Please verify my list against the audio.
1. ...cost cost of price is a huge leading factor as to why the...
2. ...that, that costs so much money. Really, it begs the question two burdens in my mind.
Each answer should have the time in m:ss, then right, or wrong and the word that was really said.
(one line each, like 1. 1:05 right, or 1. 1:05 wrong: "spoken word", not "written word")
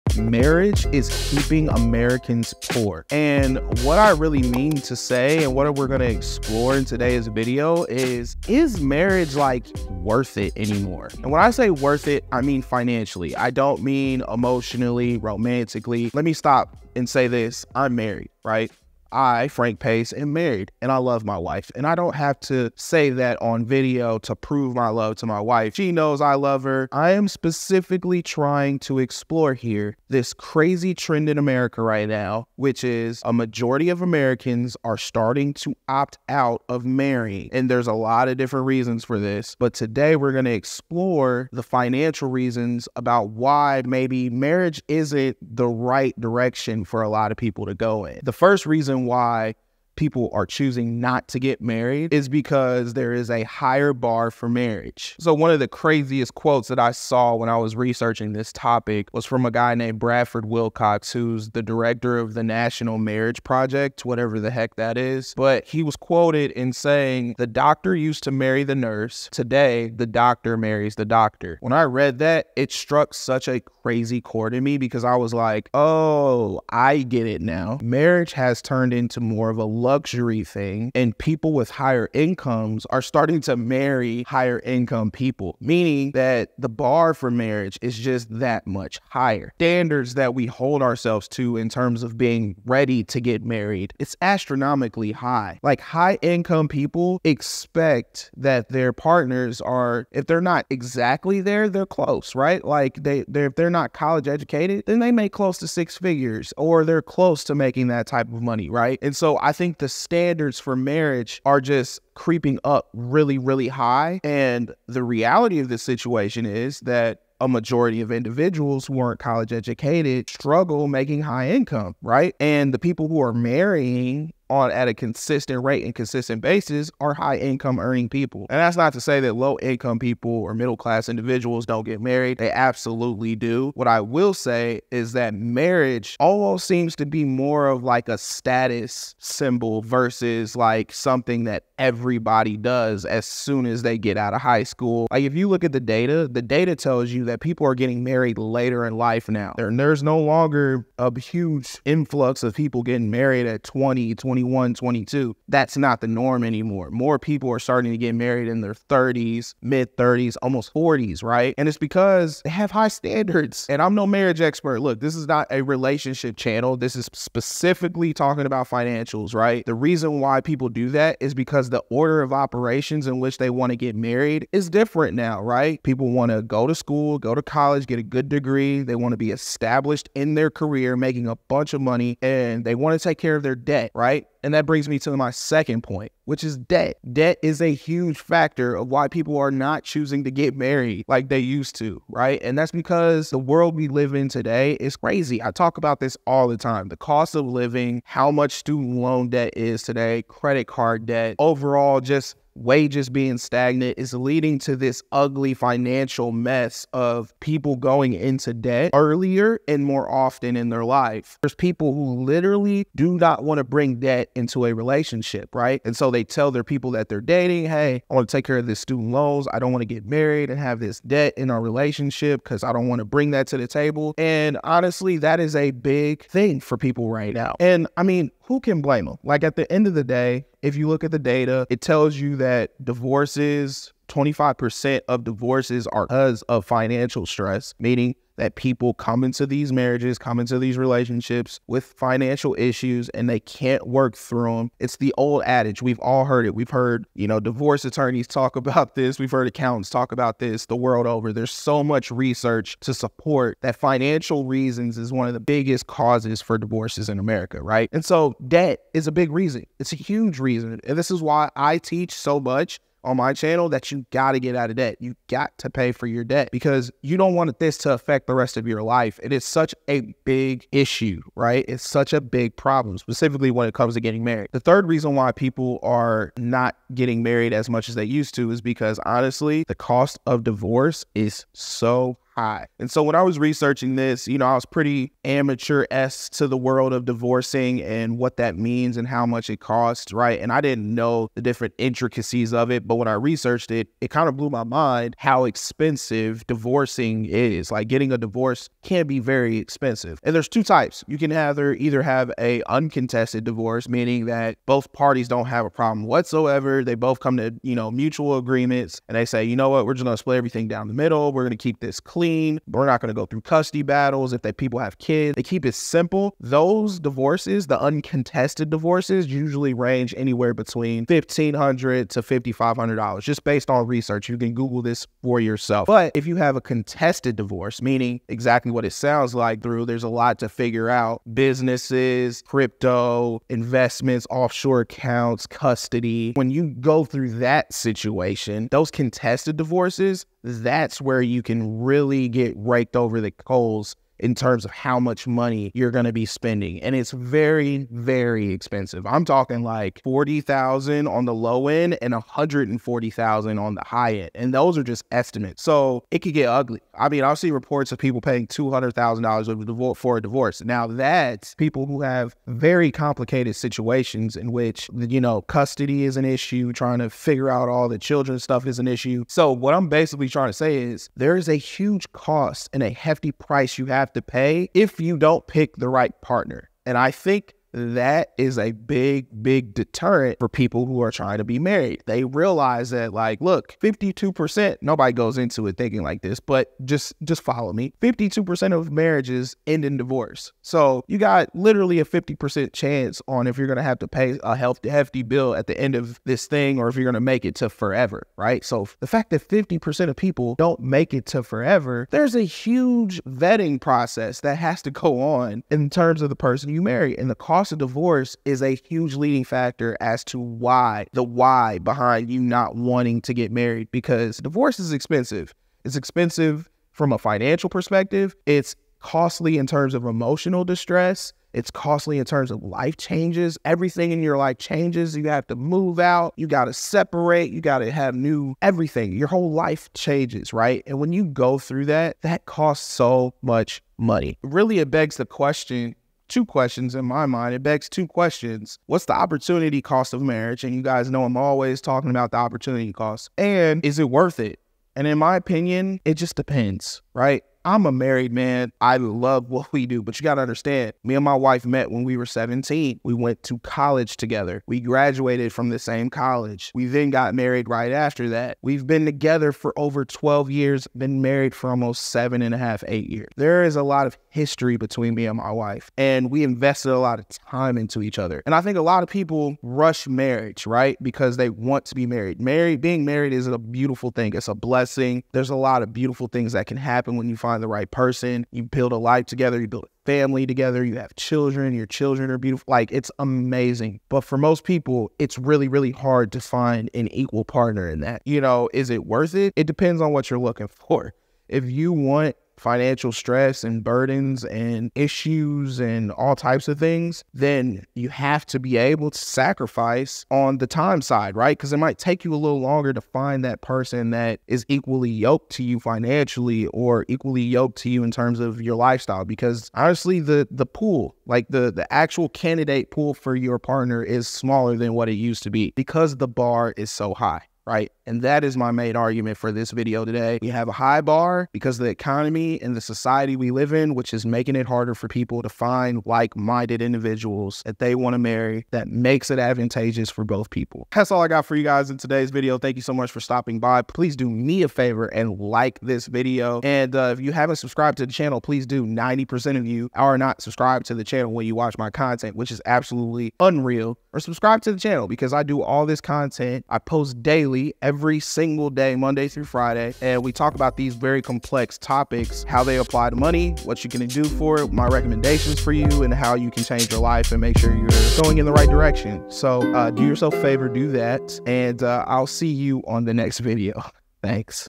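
1. 6:47 wrong: "divorce", not "price"
2. 7:11 wrong: "questions", not "burdens".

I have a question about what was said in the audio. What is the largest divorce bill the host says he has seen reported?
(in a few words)
$200,000.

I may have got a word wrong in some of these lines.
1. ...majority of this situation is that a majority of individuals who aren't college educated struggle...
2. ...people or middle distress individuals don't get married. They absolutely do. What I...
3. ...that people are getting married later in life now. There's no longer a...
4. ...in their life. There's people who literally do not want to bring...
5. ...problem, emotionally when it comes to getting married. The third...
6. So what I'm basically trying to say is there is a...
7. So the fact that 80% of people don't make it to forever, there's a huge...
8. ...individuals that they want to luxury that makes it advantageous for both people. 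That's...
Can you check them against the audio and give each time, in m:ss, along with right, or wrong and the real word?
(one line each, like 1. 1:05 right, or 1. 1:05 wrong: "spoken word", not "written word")
1. 1:55 wrong: "reality", not "majority"
2. 2:09 wrong: "class", not "distress"
3. 2:27 right
4. 3:30 right
5. 4:32 wrong: "specifically", not "emotionally"
6. 6:09 right
7. 6:38 wrong: "50", not "80"
8. 8:46 wrong: "marry", not "luxury".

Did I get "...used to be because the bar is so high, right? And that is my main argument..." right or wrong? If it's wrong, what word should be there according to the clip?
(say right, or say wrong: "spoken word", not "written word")
right.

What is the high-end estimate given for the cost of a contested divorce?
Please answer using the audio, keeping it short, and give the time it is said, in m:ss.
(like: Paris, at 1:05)
$140,000, at 5:52.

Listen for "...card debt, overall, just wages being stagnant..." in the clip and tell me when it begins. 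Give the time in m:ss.
3:20.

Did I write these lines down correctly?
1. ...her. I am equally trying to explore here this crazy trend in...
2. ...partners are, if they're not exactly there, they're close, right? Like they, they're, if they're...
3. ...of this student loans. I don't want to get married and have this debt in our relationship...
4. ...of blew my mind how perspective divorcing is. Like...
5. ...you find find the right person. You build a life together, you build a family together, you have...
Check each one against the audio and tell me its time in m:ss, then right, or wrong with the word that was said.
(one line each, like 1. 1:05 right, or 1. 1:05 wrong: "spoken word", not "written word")
1. 0:26 wrong: "specifically", not "equally"
2. 1:38 right
3. 3:38 right
4. 4:54 wrong: "expensive", not "perspective"
5. 7:57 right.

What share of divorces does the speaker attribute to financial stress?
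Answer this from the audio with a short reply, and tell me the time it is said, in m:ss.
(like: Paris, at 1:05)
25%, at 3:54.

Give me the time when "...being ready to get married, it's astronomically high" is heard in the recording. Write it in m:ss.
1:32.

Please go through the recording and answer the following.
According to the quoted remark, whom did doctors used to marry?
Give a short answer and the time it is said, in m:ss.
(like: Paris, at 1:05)
the nurse, at 1:08.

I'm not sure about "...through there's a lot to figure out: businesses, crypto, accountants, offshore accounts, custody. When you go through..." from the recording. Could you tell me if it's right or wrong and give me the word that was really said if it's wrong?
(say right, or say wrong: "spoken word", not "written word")
wrong: "investments", not "accountants".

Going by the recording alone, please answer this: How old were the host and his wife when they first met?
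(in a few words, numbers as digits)
17.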